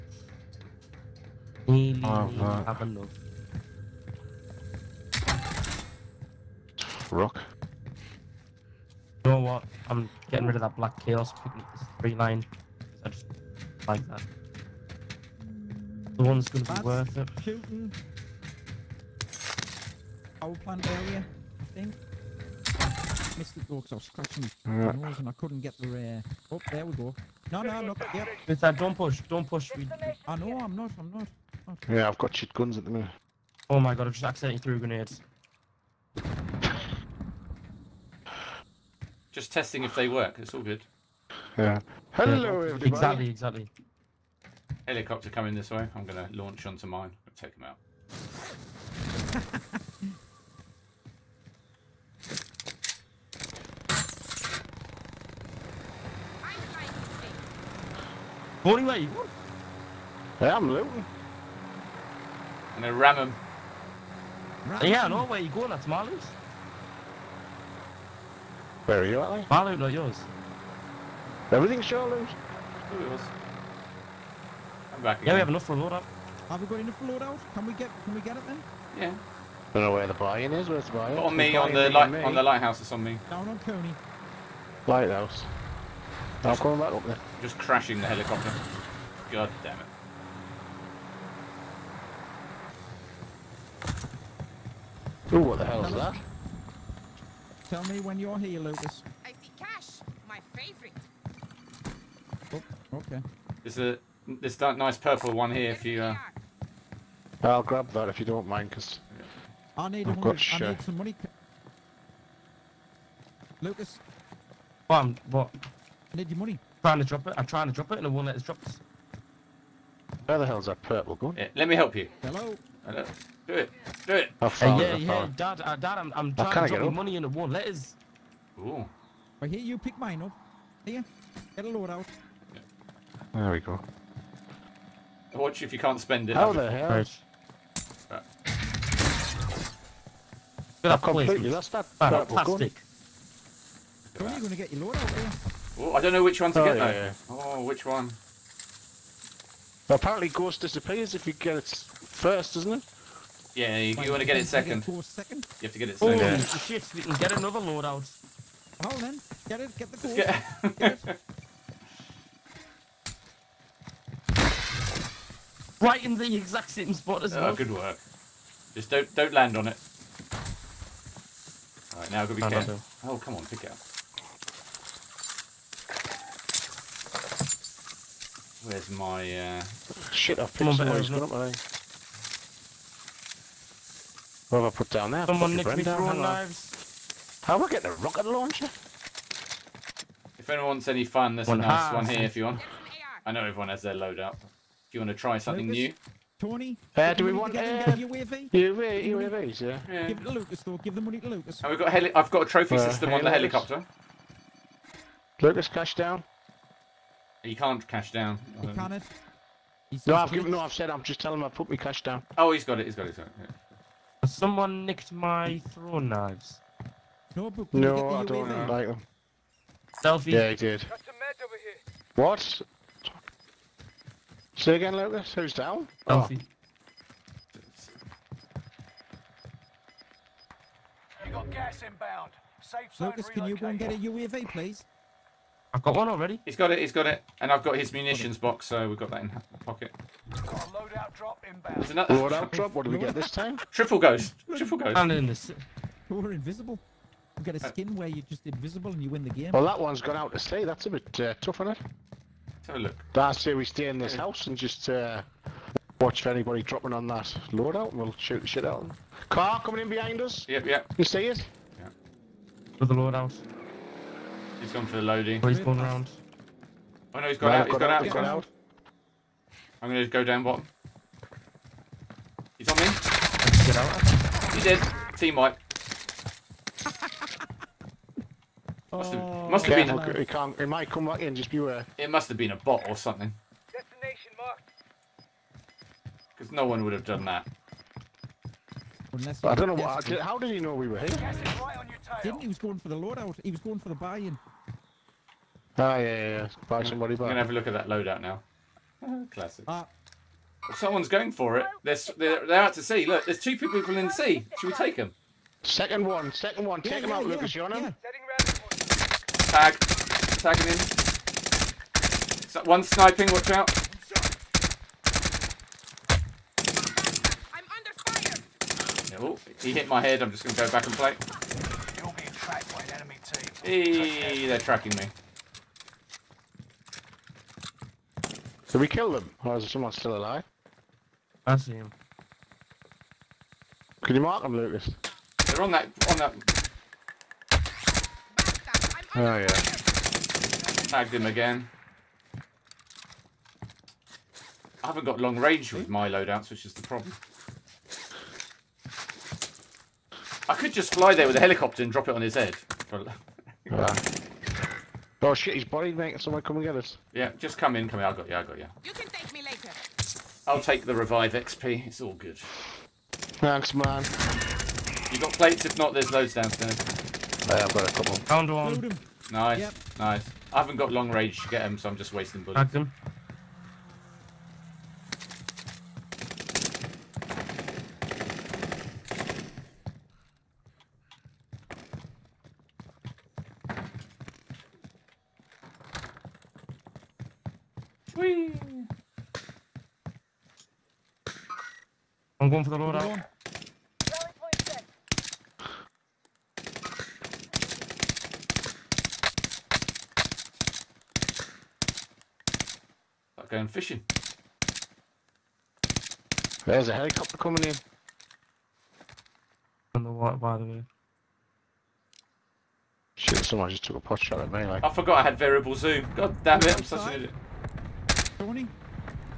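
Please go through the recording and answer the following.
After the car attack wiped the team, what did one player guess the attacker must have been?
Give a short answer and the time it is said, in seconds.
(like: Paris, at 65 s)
A bot, at 282 s.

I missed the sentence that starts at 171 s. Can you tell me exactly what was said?
All right, now I've got to be careful.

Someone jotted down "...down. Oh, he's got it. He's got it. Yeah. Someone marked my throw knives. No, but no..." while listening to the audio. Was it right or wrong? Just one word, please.
wrong.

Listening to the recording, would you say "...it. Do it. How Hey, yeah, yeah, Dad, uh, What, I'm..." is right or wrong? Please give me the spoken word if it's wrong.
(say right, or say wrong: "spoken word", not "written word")
wrong: "Dad", not "What".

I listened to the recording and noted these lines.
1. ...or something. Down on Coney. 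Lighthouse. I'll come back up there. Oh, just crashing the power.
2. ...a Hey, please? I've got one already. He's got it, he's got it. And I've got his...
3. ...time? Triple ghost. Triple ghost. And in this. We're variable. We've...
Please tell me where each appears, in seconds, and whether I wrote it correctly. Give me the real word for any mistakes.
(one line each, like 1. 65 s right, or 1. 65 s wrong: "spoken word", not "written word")
1. 82 s wrong: "helicopter", not "power"
2. 233 s wrong: "UAV", not "Hey"
3. 243 s wrong: "invisible", not "variable".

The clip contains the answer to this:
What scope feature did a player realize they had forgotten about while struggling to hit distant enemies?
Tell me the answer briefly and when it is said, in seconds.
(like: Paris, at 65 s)
Variable zoom, at 415 s.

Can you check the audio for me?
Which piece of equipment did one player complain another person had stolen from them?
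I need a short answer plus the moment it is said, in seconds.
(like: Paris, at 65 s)
Throwing knives, at 185 s.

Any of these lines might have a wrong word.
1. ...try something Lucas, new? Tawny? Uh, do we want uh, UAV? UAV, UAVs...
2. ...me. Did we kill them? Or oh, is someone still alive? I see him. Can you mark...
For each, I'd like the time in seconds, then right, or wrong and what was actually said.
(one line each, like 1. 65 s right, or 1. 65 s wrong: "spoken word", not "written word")
1. 195 s right
2. 324 s right.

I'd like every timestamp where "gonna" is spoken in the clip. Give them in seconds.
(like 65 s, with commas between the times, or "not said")
16 s, 46 s, 62 s, 269 s, 297 s.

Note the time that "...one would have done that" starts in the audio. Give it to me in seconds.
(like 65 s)
286 s.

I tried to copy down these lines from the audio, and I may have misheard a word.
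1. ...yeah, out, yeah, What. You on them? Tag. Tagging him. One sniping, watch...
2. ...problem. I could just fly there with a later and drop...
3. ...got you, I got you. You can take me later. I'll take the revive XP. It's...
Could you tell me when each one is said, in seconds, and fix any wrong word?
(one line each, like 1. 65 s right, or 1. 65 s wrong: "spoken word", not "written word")
1. 307 s wrong: "Lucas", not "What"
2. 346 s wrong: "helicopter", not "later"
3. 358 s right.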